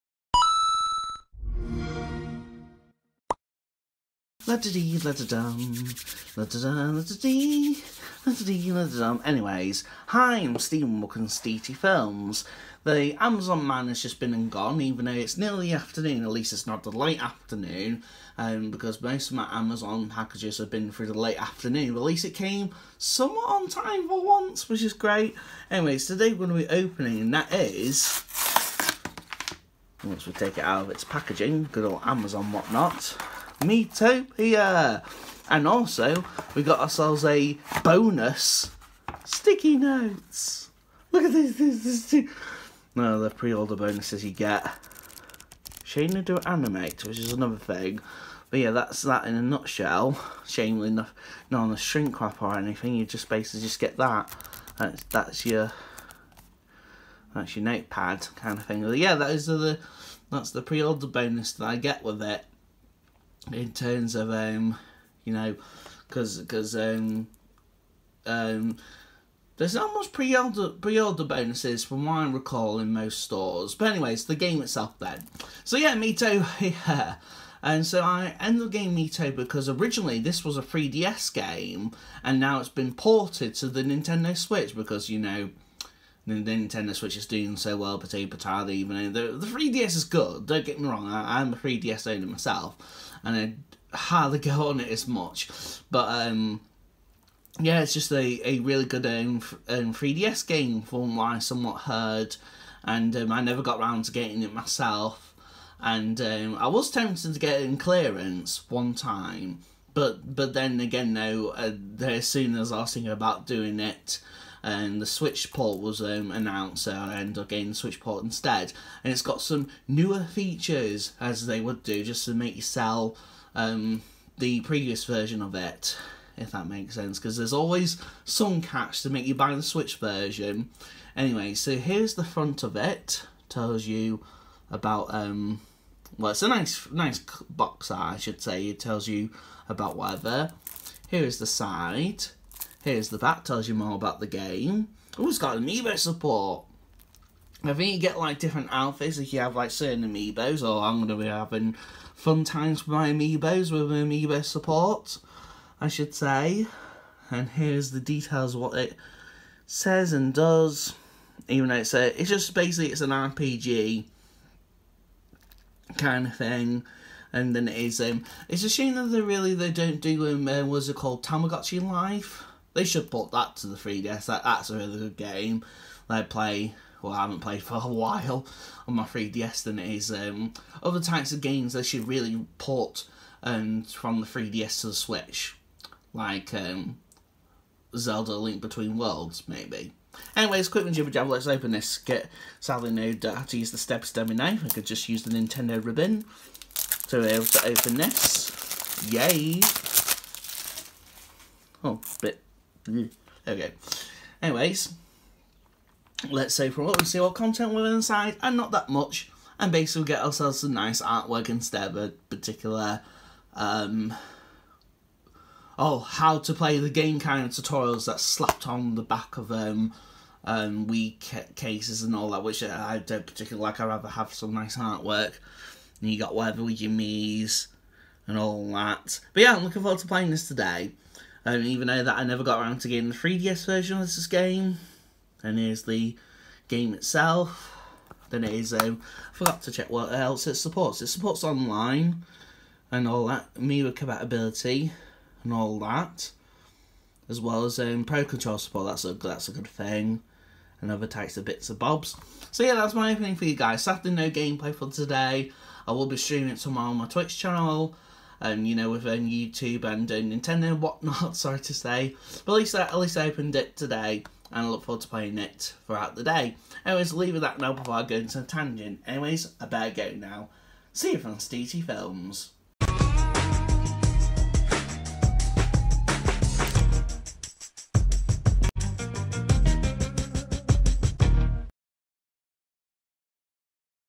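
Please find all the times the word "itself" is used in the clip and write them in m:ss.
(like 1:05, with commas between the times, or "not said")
1:14, 3:56.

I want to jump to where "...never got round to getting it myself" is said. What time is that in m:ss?
1:43.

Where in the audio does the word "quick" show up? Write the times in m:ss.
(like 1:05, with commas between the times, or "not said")
3:10.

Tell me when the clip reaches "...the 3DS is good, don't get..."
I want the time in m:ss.
1:29.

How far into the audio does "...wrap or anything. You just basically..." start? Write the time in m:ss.
0:52.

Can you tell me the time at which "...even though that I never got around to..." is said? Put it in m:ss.
3:51.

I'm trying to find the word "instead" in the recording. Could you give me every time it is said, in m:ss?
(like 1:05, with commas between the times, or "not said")
1:58, 3:31.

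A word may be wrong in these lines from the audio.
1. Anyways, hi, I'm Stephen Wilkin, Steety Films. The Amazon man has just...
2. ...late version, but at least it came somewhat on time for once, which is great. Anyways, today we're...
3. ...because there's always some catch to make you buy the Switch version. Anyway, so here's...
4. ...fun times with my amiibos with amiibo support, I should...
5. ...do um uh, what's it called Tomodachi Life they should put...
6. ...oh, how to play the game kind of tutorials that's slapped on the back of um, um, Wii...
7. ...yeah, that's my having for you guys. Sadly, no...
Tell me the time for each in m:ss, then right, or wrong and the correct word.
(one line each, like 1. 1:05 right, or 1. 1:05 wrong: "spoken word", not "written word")
1. 0:09 right
2. 0:21 wrong: "afternoon", not "version"
3. 2:07 right
4. 2:32 right
5. 2:49 right
6. 3:35 right
7. 4:12 wrong: "opening", not "having".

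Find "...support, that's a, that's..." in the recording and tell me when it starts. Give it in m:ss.
4:08.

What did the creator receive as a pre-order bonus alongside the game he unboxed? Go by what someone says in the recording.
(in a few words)
sticky notes.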